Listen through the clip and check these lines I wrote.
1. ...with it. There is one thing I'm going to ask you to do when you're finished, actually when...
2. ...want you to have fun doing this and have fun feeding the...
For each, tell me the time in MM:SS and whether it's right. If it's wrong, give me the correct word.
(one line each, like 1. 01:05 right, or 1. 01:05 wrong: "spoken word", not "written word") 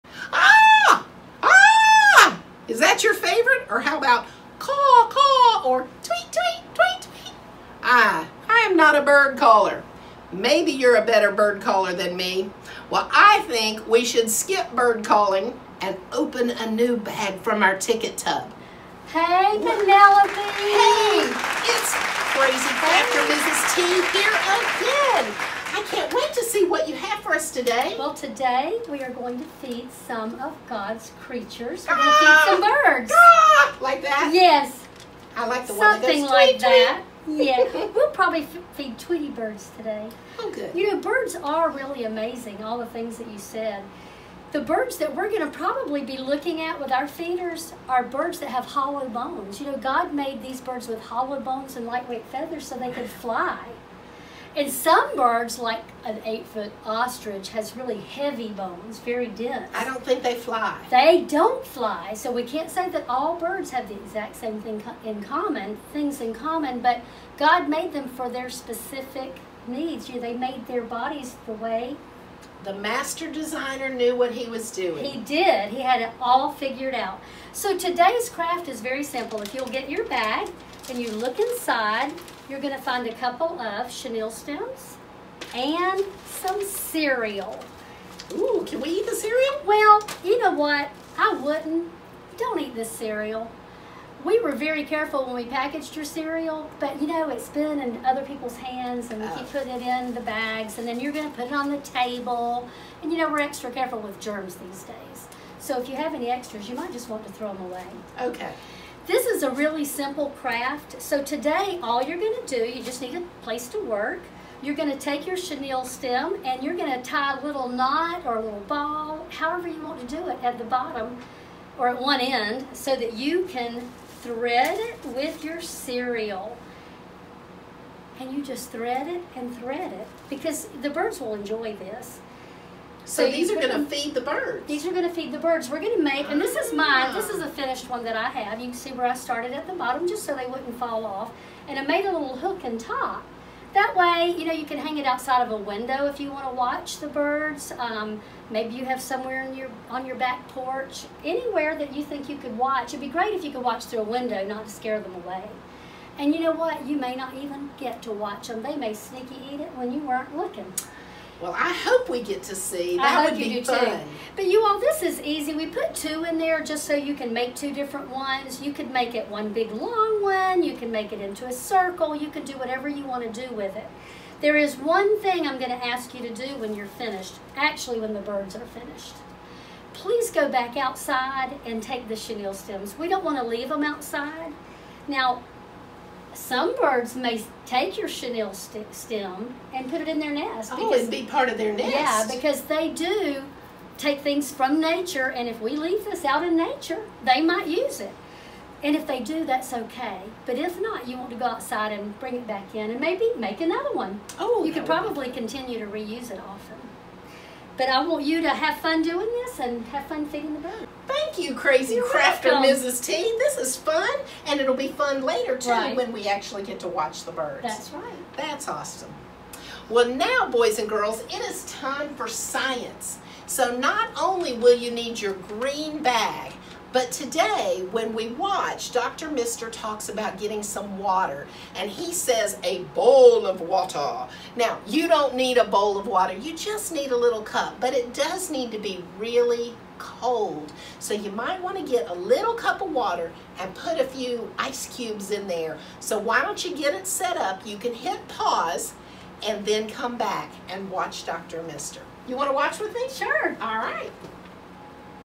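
1. 02:53 right
2. 03:28 right.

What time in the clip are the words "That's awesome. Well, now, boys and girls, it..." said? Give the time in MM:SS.
03:38.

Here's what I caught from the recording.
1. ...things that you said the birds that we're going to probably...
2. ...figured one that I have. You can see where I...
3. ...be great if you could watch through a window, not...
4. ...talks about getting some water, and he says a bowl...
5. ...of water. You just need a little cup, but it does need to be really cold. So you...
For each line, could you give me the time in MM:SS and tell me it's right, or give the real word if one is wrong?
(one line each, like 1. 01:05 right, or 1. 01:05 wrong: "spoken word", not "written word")
1. 00:42 right
2. 02:17 wrong: "finished", not "figured"
3. 02:32 right
4. 03:49 right
5. 03:55 right.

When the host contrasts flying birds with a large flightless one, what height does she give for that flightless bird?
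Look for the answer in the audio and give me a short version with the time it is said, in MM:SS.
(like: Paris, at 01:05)
8 feet, at 00:56.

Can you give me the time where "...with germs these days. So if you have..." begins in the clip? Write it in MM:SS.
01:43.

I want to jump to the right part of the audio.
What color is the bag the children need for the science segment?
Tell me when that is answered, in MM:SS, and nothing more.
03:45.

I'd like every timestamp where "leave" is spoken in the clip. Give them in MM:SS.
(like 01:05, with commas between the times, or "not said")
03:03, 03:15.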